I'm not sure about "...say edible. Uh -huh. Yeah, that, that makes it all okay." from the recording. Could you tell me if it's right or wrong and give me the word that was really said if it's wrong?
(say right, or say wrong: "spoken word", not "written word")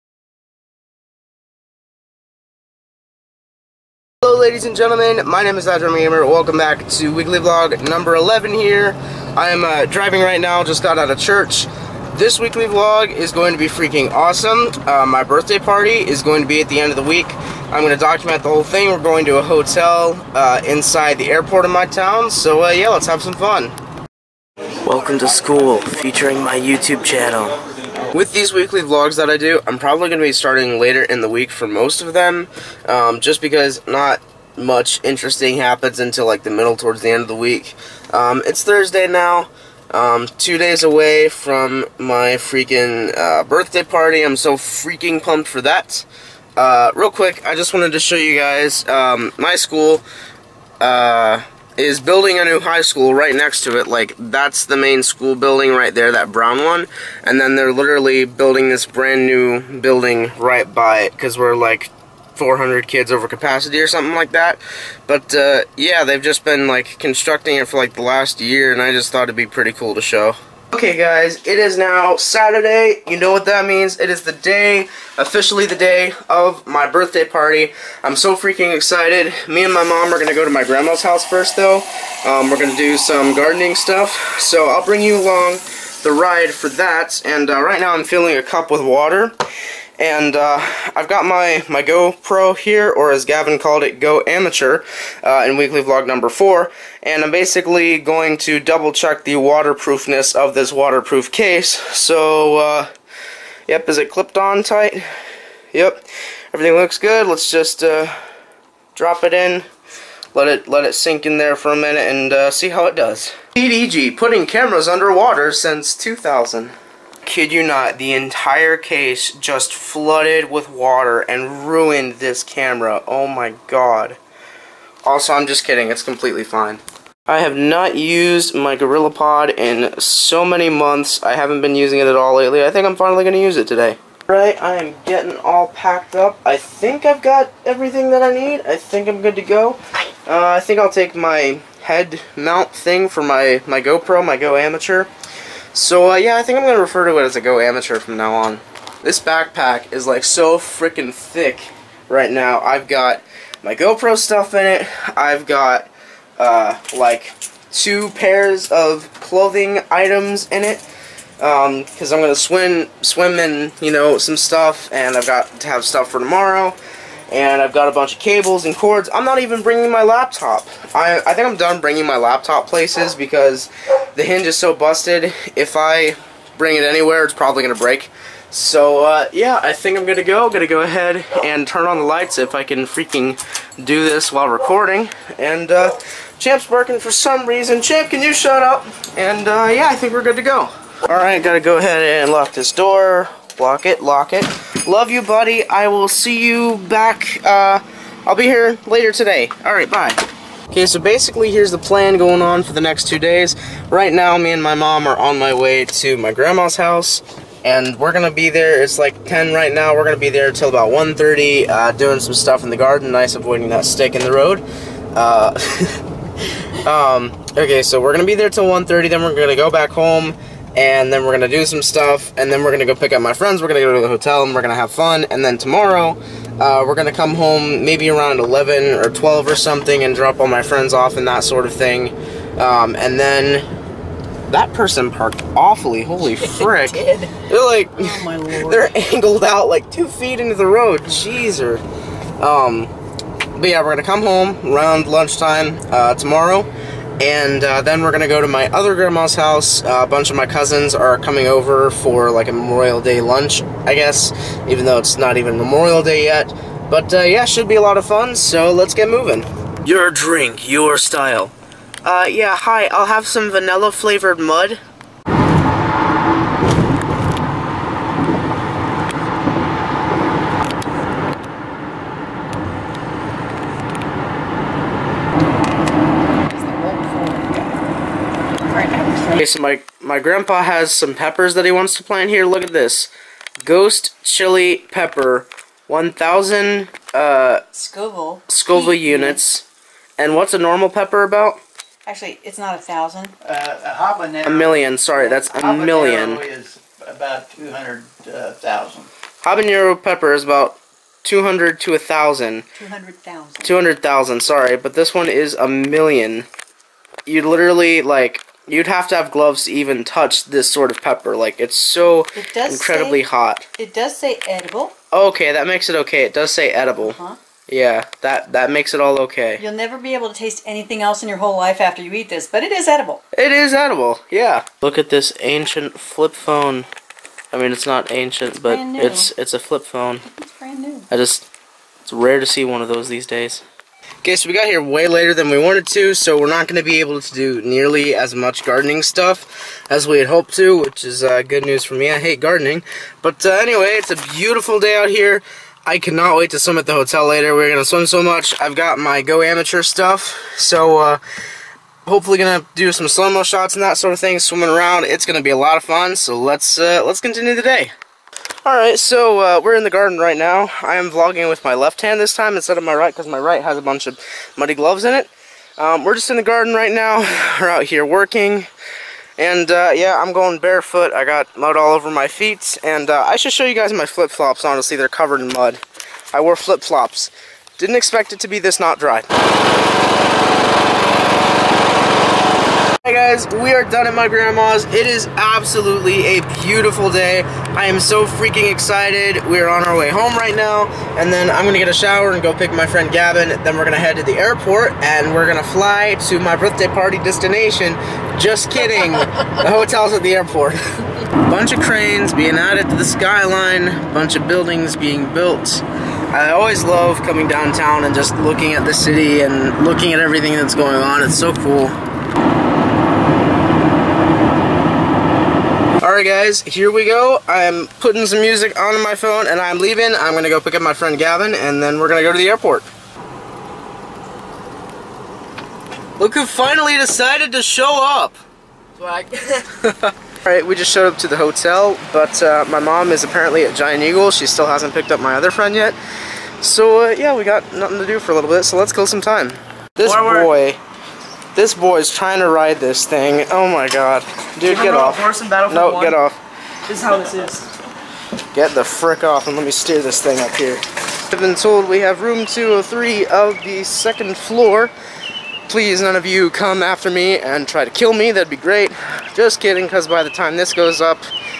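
right.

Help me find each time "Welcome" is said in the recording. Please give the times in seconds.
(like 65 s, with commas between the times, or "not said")
6 s, 24 s.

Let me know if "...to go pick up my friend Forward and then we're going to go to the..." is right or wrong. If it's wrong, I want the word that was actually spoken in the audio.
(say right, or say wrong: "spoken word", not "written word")
wrong: "Gavin", not "Forward".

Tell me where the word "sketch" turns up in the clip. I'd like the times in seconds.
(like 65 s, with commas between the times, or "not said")
not said.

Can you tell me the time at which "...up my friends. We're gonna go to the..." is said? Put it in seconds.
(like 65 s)
223 s.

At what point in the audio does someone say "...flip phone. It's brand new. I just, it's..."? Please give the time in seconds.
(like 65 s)
329 s.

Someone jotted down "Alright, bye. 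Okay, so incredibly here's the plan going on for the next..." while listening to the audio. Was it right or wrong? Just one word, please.
wrong.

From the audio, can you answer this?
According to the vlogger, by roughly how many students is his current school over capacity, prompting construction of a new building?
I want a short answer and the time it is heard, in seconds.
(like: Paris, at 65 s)
400, at 62 s.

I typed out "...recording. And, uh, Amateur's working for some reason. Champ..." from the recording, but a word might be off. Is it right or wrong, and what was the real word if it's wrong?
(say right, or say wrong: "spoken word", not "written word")
wrong: "Champ", not "Amateur".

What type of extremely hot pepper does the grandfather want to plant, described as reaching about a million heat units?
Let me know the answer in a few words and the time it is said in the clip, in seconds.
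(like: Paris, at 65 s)
Ghost chili pepper, at 283 s.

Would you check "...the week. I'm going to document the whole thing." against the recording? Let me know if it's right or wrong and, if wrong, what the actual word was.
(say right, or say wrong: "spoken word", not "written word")
right.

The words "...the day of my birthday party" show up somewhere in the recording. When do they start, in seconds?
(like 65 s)
75 s.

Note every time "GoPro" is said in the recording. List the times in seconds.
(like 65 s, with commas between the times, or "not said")
91 s, 143 s, 153 s.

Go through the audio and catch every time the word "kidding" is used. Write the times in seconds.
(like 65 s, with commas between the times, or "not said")
125 s, 398 s, 459 s.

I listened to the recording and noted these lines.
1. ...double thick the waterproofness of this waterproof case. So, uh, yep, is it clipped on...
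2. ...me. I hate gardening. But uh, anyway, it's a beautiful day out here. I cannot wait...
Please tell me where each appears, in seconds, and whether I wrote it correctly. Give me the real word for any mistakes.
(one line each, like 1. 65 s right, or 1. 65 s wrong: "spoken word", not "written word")
1. 98 s wrong: "check", not "thick"
2. 341 s right.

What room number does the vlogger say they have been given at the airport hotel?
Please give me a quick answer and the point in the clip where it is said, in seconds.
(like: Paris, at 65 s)
203, at 452 s.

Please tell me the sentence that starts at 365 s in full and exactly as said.
Um, we're just in the garden right now.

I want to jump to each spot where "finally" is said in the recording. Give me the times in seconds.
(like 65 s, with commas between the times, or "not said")
132 s, 426 s.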